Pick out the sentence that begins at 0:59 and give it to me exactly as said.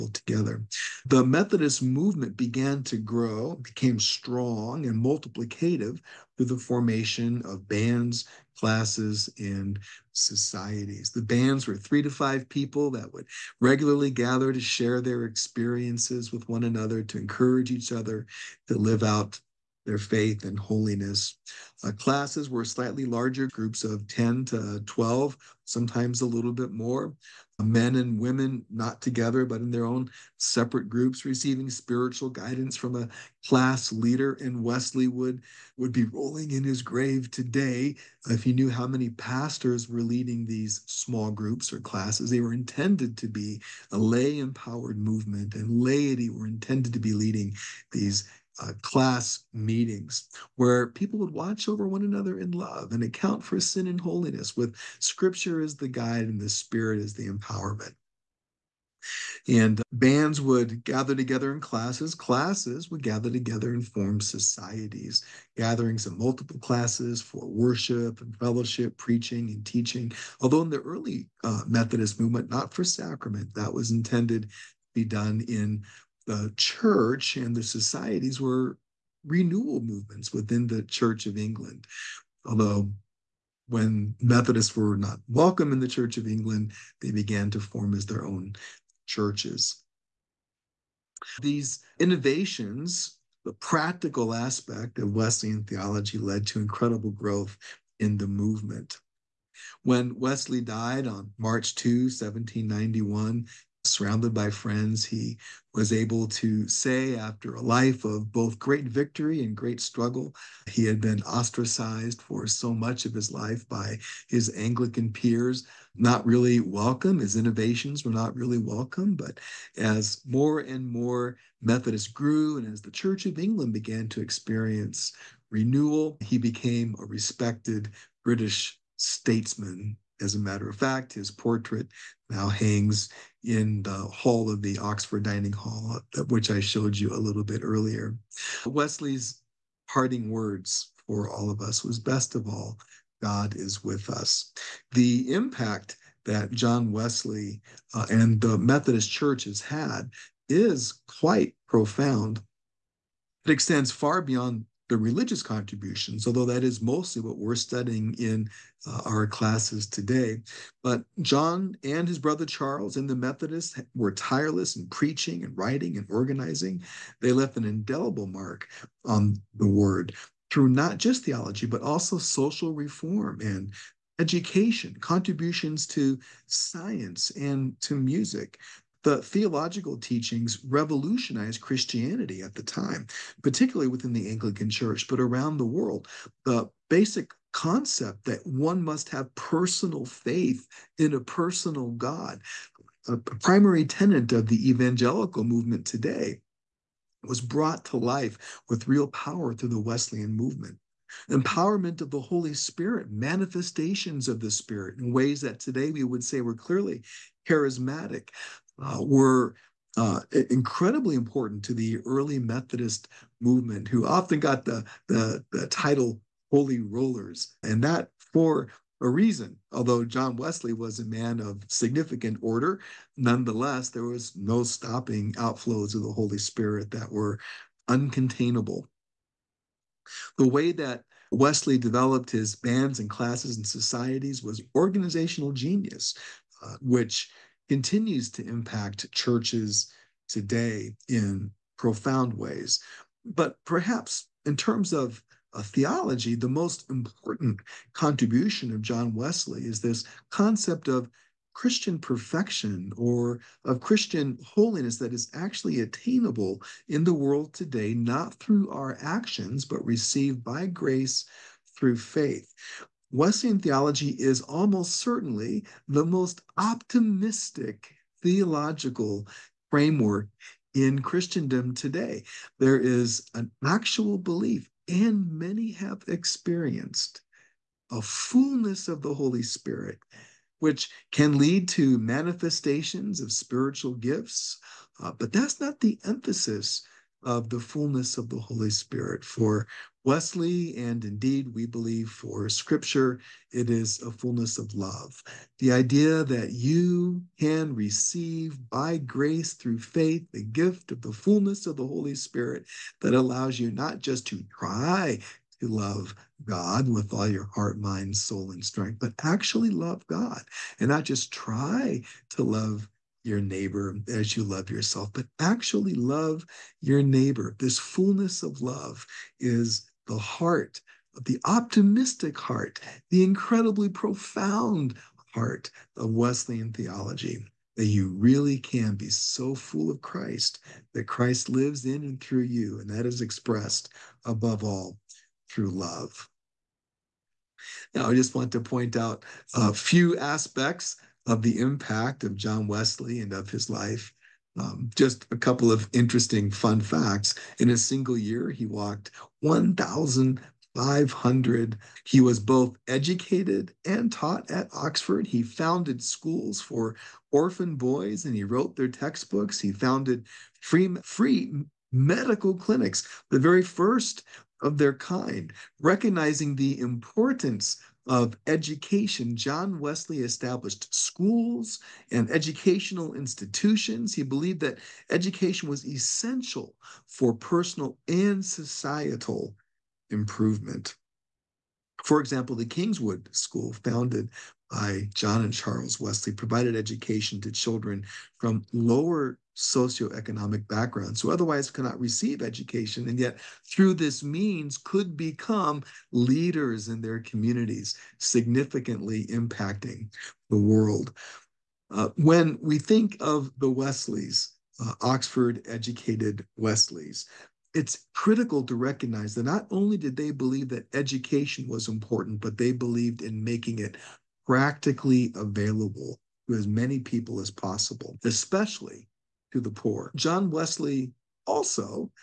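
And bands would gather together in classes.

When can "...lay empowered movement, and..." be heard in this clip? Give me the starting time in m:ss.
0:43.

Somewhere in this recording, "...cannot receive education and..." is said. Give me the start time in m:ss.
6:31.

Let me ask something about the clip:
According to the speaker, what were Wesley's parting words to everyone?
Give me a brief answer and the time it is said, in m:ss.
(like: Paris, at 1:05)
Best of all, God is with us, at 2:21.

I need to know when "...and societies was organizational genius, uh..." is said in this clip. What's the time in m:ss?
3:53.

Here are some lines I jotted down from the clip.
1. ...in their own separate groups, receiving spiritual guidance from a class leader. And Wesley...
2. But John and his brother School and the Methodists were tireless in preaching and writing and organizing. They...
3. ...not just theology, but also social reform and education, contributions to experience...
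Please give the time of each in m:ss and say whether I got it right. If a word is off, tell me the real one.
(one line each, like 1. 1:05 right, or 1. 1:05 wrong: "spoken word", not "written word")
1. 0:29 right
2. 2:40 wrong: "Charles", not "School"
3. 2:50 wrong: "science", not "experience".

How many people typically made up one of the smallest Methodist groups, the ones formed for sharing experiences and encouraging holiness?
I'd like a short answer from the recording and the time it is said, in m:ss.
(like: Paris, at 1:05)
3 to 5, at 0:11.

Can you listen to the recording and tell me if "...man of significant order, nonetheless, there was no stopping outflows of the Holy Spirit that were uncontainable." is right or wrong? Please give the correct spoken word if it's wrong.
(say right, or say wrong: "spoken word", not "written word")
right.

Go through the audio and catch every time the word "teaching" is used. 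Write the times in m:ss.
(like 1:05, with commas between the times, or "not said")
1:09, 2:59.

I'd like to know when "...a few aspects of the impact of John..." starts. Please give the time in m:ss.
5:39.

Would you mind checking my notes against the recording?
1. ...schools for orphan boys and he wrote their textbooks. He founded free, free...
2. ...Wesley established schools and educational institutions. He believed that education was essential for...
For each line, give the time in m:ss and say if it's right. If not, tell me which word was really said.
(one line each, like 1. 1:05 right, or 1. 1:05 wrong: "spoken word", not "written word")
1. 5:56 right
2. 6:09 right.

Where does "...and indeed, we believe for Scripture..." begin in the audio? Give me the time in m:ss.
4:50.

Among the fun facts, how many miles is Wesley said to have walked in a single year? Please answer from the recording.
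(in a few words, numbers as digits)
1,500.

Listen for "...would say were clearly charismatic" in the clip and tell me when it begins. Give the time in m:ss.
3:26.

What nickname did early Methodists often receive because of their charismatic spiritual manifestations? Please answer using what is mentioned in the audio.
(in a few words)
Holy Rollers.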